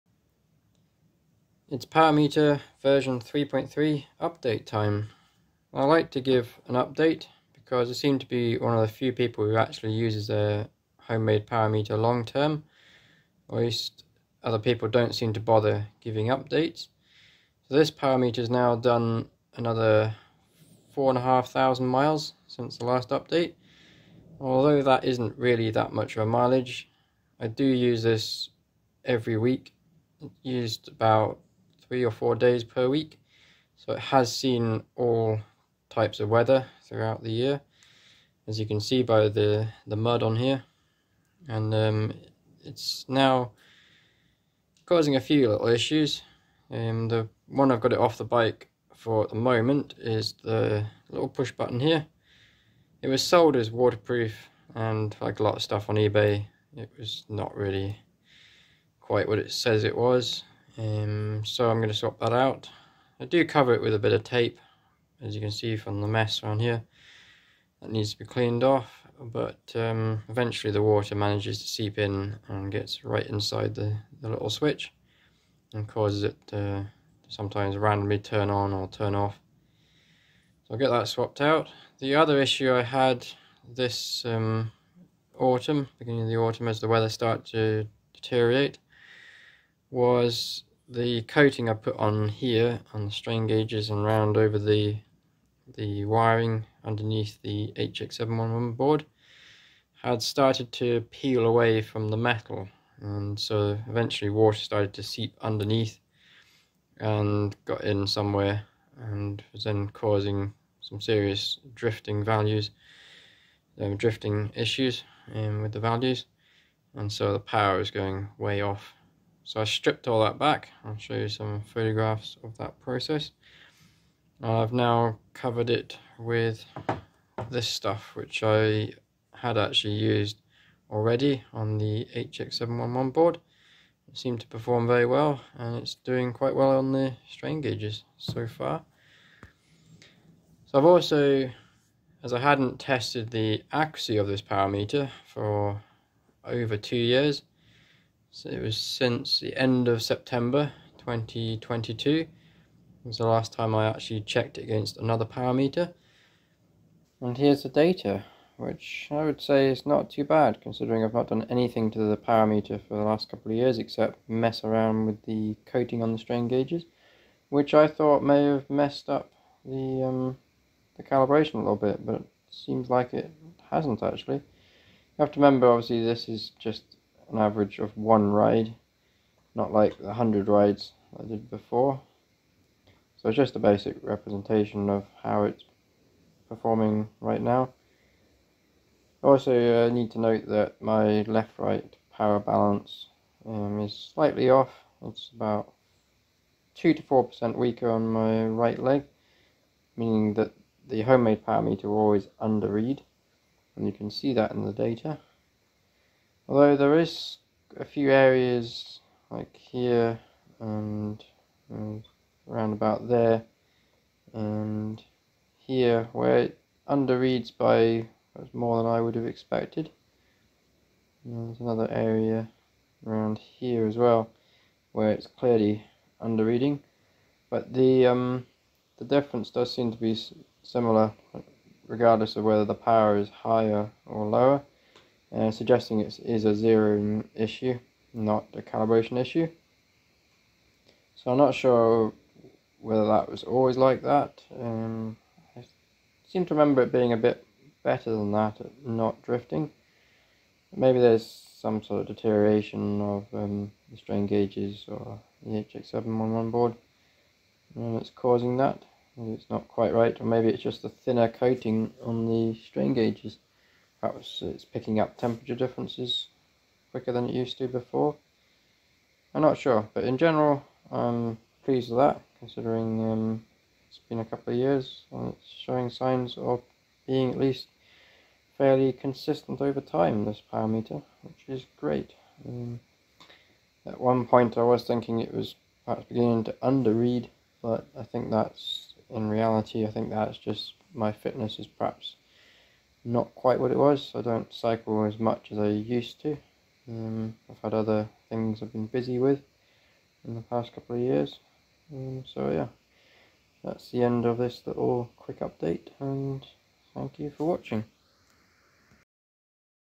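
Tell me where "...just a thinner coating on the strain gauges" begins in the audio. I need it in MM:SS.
04:20.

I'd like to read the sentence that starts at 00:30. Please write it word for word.
used about three or four days per week.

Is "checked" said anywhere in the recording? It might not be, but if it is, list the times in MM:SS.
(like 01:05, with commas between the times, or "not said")
02:34.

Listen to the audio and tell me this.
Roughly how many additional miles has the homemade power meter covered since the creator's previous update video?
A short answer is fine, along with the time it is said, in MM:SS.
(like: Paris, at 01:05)
4,500 miles, at 00:20.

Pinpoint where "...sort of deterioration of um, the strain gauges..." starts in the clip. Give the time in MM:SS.
04:11.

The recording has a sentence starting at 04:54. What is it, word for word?
I don't cycle as much as I used to.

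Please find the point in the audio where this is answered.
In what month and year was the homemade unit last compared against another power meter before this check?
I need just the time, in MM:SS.
02:30.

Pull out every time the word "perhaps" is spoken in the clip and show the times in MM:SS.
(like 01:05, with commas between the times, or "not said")
04:24, 04:45, 04:51.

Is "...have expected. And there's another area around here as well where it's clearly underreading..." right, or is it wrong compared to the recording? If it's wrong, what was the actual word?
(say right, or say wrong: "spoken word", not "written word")
right.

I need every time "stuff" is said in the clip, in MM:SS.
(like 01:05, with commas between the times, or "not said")
00:55, 02:07.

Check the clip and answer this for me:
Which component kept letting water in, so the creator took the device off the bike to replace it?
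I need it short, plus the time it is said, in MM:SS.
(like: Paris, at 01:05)
push button, at 00:51.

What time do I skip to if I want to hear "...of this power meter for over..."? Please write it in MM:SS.
02:24.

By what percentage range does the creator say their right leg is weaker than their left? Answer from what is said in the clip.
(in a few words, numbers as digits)
2 to 4%.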